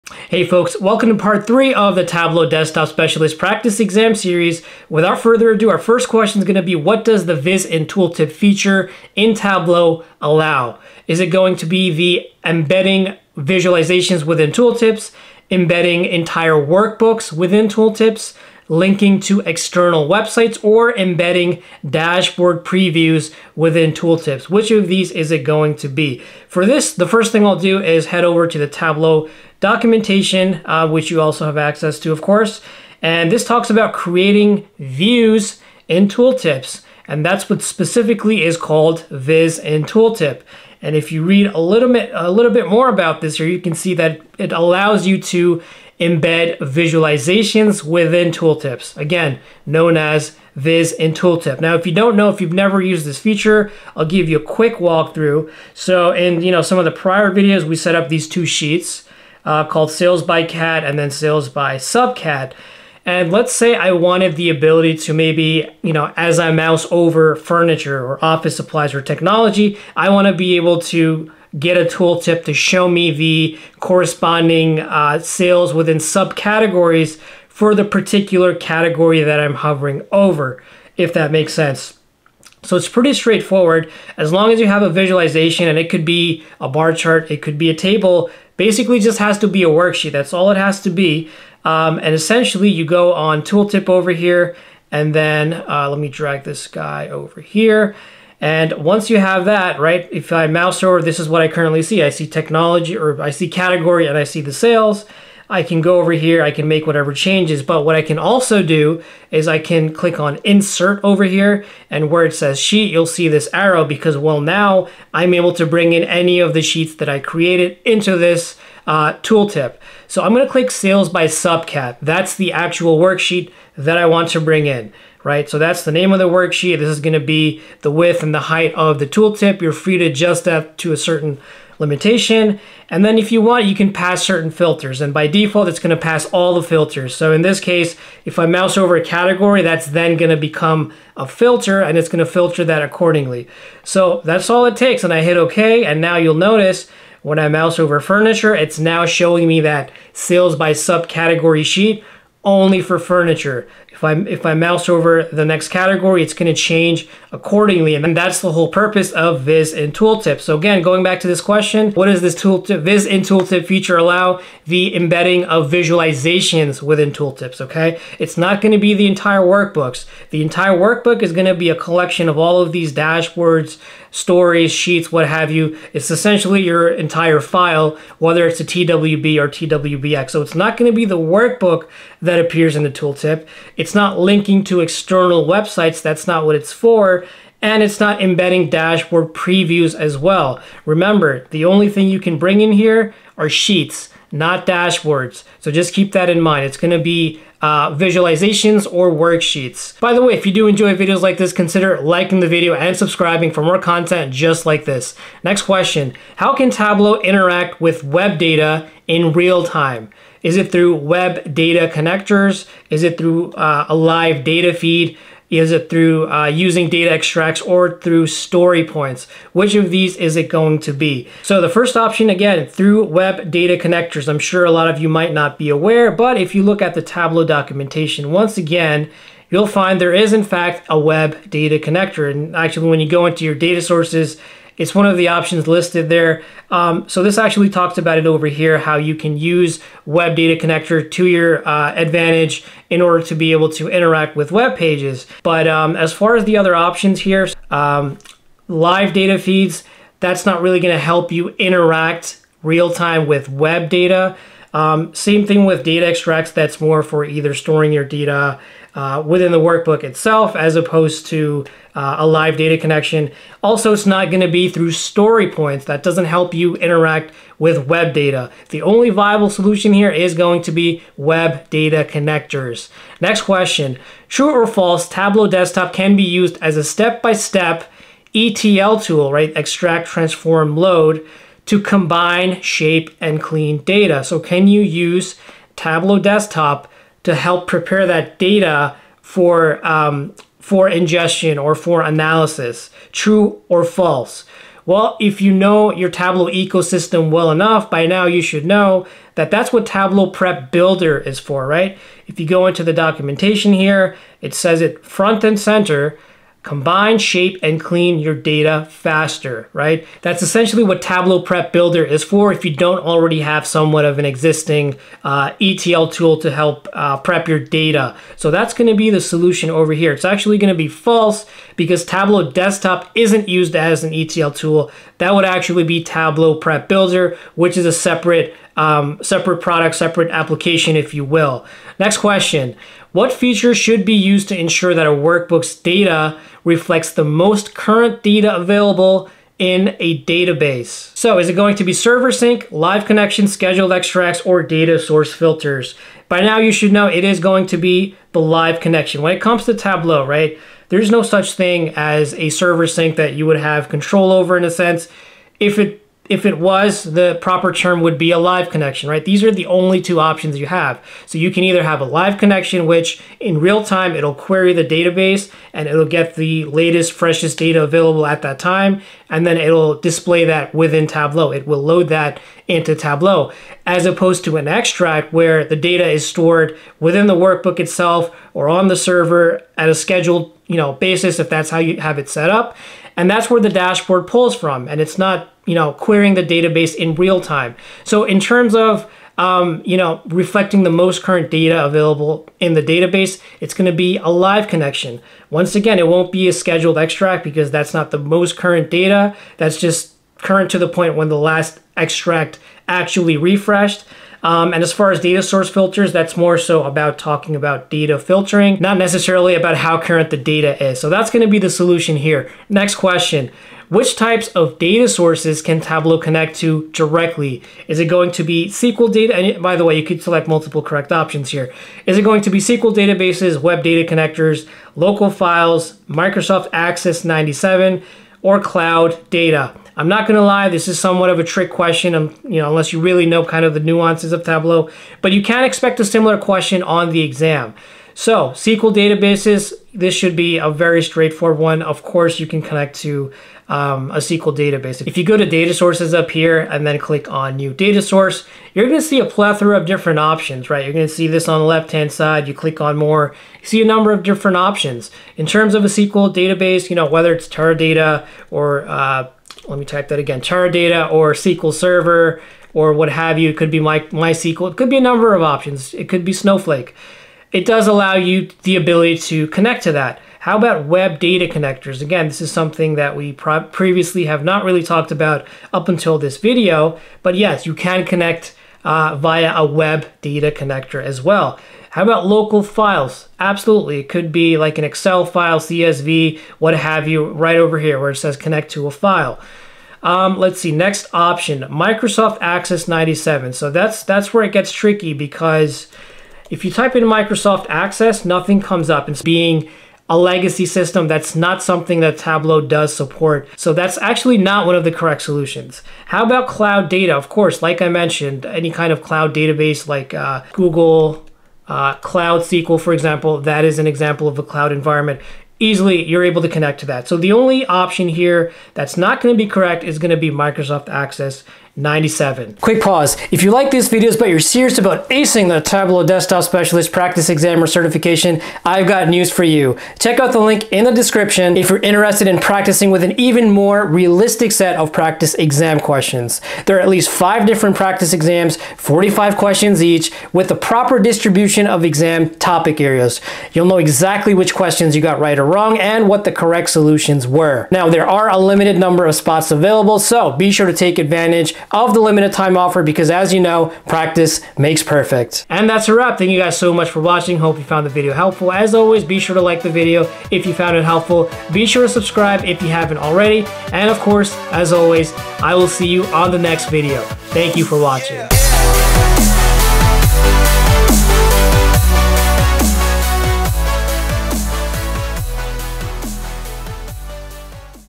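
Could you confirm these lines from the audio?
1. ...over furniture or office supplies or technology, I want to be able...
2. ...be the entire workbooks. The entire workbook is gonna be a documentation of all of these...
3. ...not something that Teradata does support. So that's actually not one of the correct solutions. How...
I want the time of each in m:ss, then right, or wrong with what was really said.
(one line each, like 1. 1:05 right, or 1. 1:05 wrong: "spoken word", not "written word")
1. 1:06 right
2. 2:48 wrong: "collection", not "documentation"
3. 8:21 wrong: "Tableau", not "Teradata".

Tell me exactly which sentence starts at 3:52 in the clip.
And actually when you go into your data sources, it's one of the options listed there.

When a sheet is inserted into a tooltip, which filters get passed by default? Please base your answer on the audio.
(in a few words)
all the filters.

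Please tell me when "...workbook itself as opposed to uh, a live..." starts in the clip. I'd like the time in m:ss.
4:19.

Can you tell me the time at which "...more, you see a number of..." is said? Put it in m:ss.
7:32.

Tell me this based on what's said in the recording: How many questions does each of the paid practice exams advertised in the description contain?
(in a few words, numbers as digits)
45.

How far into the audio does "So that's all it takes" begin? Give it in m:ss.
2:23.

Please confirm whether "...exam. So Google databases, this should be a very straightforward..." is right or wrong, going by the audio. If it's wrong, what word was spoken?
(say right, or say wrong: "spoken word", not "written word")
wrong: "SQL", not "Google".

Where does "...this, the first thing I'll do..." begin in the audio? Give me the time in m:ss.
0:26.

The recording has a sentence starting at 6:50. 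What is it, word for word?
So that's going to be the solution here.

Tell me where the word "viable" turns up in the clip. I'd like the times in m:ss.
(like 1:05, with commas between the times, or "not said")
4:29.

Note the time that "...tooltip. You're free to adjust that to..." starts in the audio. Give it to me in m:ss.
2:09.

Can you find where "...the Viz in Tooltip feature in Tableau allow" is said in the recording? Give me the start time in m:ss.
0:07.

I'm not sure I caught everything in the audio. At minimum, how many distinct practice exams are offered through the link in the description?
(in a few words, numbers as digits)
5.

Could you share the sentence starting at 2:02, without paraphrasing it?
That's the actual worksheet that I want to bring in right?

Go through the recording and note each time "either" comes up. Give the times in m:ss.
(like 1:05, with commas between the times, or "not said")
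4:17, 6:01.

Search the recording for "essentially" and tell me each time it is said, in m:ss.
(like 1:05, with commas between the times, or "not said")
1:32, 2:56, 5:10.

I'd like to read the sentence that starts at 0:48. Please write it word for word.
Again, known as Viz in Tooltip.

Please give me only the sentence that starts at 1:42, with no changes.
I see technology or I see category and I see the sales.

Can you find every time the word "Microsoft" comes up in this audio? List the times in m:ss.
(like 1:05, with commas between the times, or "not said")
7:06, 8:11, 8:17, 8:40.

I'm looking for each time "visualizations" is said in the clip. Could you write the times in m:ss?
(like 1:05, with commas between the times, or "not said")
0:13, 0:46, 1:24, 2:45, 3:17.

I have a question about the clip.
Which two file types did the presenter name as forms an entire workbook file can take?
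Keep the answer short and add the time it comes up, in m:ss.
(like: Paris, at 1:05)
TWB or TWBX, at 2:58.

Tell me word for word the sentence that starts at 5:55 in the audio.
If it if it was, the proper term would be a live connection, right?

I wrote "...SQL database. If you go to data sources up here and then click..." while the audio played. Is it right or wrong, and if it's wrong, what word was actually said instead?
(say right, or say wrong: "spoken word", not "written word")
right.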